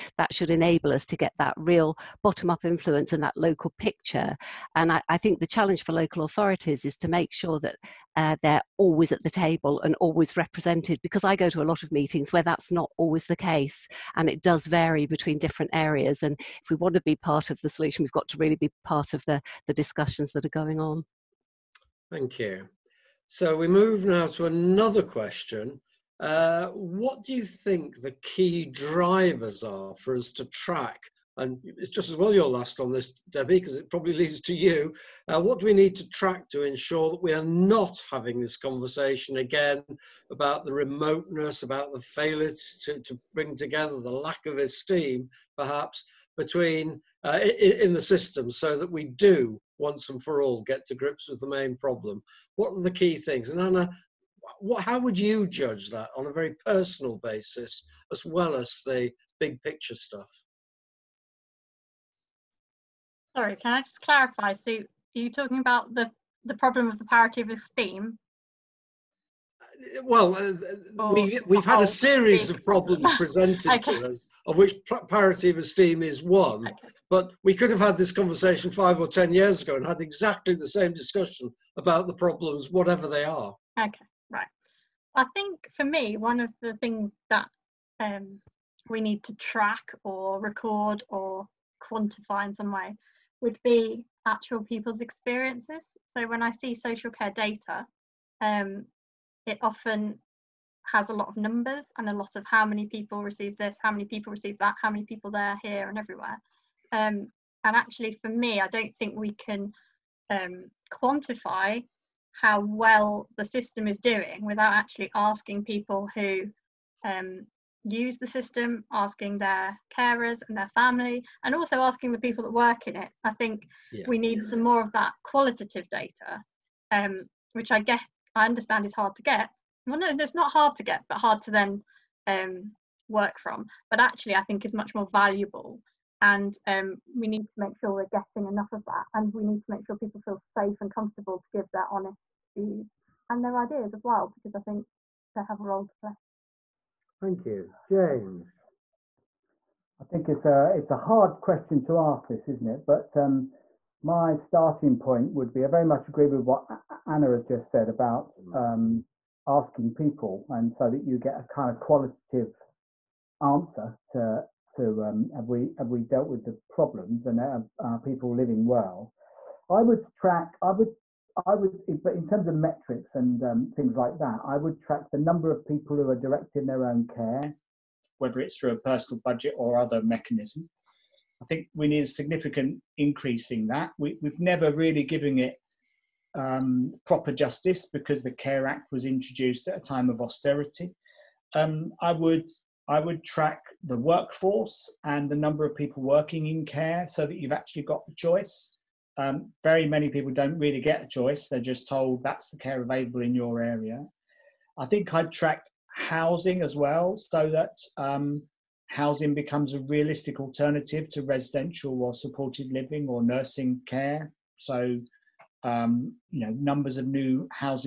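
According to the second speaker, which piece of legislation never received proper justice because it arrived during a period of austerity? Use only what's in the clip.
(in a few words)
the Care Act.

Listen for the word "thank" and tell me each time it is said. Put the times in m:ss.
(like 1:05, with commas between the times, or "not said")
0:22, 2:27.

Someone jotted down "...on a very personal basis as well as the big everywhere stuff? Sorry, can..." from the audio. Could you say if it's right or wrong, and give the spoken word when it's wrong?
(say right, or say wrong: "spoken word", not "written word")
wrong: "picture", not "everywhere".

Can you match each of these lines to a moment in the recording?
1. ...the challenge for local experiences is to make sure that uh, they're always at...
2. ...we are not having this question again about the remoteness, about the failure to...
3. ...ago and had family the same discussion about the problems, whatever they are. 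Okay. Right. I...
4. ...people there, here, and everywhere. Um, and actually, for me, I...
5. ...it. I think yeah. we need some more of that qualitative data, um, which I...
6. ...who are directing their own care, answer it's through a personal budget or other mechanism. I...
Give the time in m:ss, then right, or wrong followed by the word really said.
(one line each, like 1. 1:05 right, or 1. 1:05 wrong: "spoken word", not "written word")
1. 0:05 wrong: "authorities", not "experiences"
2. 0:37 wrong: "conversation", not "question"
3. 1:19 wrong: "exactly", not "family"
4. 1:45 right
5. 2:02 right
6. 2:55 wrong: "whether", not "answer".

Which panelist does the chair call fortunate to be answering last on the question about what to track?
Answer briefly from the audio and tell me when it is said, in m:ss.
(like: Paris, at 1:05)
Debbie, at 0:33.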